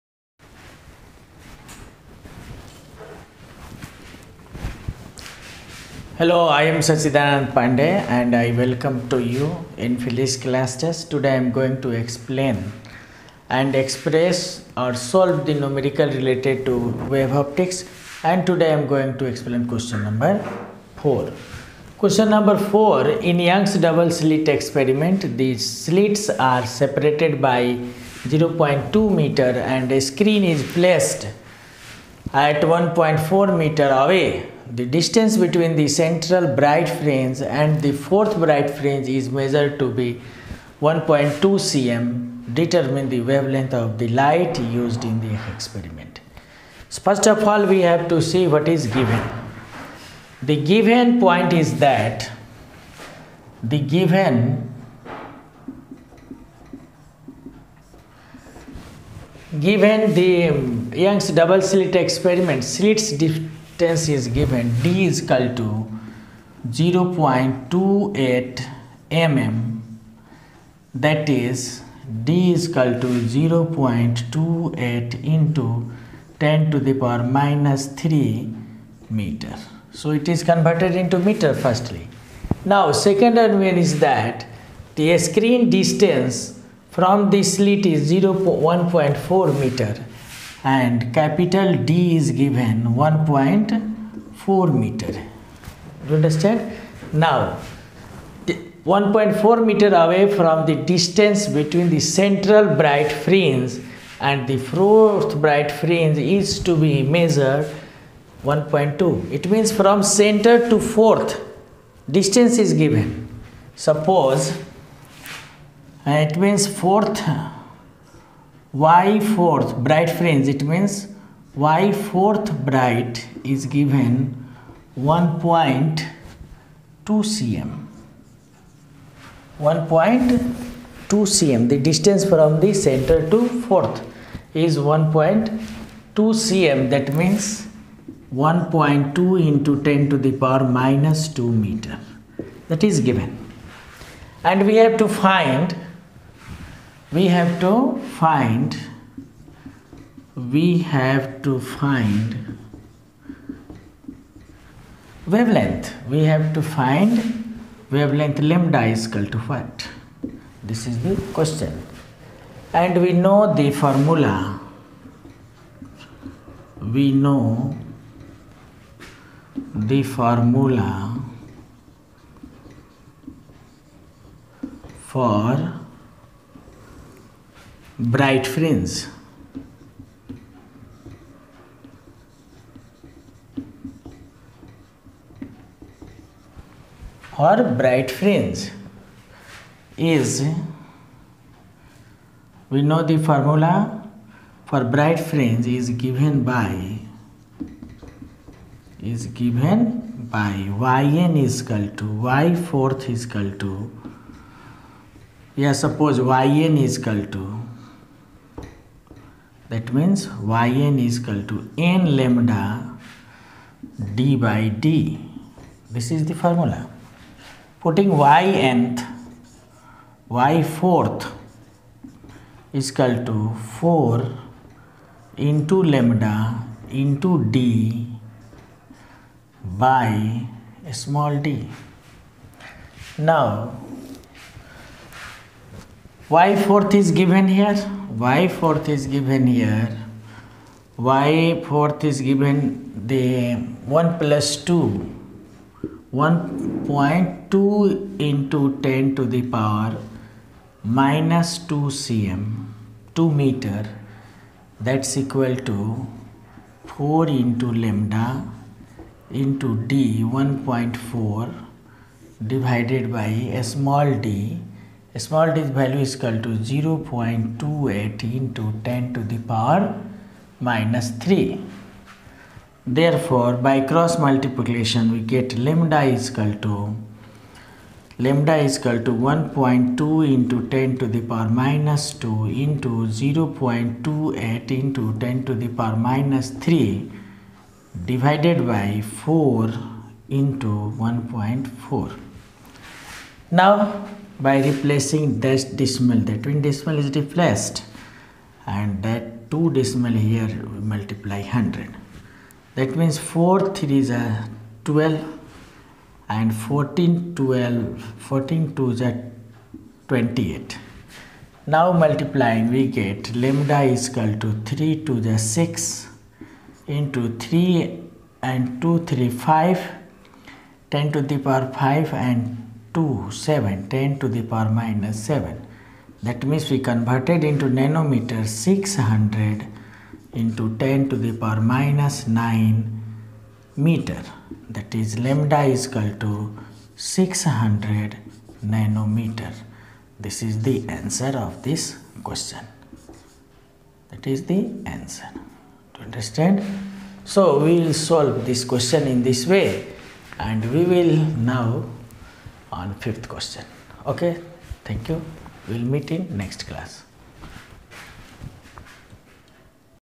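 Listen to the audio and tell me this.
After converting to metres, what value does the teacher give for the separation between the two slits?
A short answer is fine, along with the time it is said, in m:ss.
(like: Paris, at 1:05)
0.28 × 10^-3 m, at 1:13.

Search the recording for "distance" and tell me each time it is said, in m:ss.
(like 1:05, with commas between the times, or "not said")
0:34, 1:03, 1:25, 1:40, 1:52, 2:11.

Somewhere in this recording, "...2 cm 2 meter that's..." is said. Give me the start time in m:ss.
4:11.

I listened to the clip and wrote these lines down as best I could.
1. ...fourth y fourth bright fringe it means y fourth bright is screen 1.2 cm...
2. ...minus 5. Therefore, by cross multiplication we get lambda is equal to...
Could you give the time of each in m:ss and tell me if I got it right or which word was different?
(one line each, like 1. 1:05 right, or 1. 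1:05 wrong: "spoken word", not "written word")
1. 1:56 wrong: "given", not "screen"
2. 4:30 wrong: "3", not "5".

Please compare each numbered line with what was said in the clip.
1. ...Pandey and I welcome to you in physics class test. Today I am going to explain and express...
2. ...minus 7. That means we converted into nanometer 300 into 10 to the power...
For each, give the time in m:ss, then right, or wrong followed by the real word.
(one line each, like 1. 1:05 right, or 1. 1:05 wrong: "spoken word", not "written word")
1. 0:07 right
2. 5:24 wrong: "600", not "300".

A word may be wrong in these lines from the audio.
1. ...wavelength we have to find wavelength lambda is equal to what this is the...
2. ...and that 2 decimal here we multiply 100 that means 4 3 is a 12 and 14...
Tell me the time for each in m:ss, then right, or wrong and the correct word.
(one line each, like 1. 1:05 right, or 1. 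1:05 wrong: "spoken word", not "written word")
1. 2:35 right
2. 4:58 right.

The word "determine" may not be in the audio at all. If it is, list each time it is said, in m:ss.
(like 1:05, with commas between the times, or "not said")
0:42.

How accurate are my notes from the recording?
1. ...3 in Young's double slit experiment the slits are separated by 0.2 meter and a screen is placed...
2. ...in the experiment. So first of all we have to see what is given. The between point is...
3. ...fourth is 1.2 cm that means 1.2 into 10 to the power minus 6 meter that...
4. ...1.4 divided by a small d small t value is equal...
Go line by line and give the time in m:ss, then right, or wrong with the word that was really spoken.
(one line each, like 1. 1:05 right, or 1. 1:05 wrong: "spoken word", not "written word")
1. 0:22 wrong: "4", not "3"
2. 0:45 wrong: "given", not "between"
3. 2:13 wrong: "2", not "6"
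4. 4:20 right.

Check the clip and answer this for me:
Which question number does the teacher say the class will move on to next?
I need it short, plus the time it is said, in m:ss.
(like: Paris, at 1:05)
5, at 5:52.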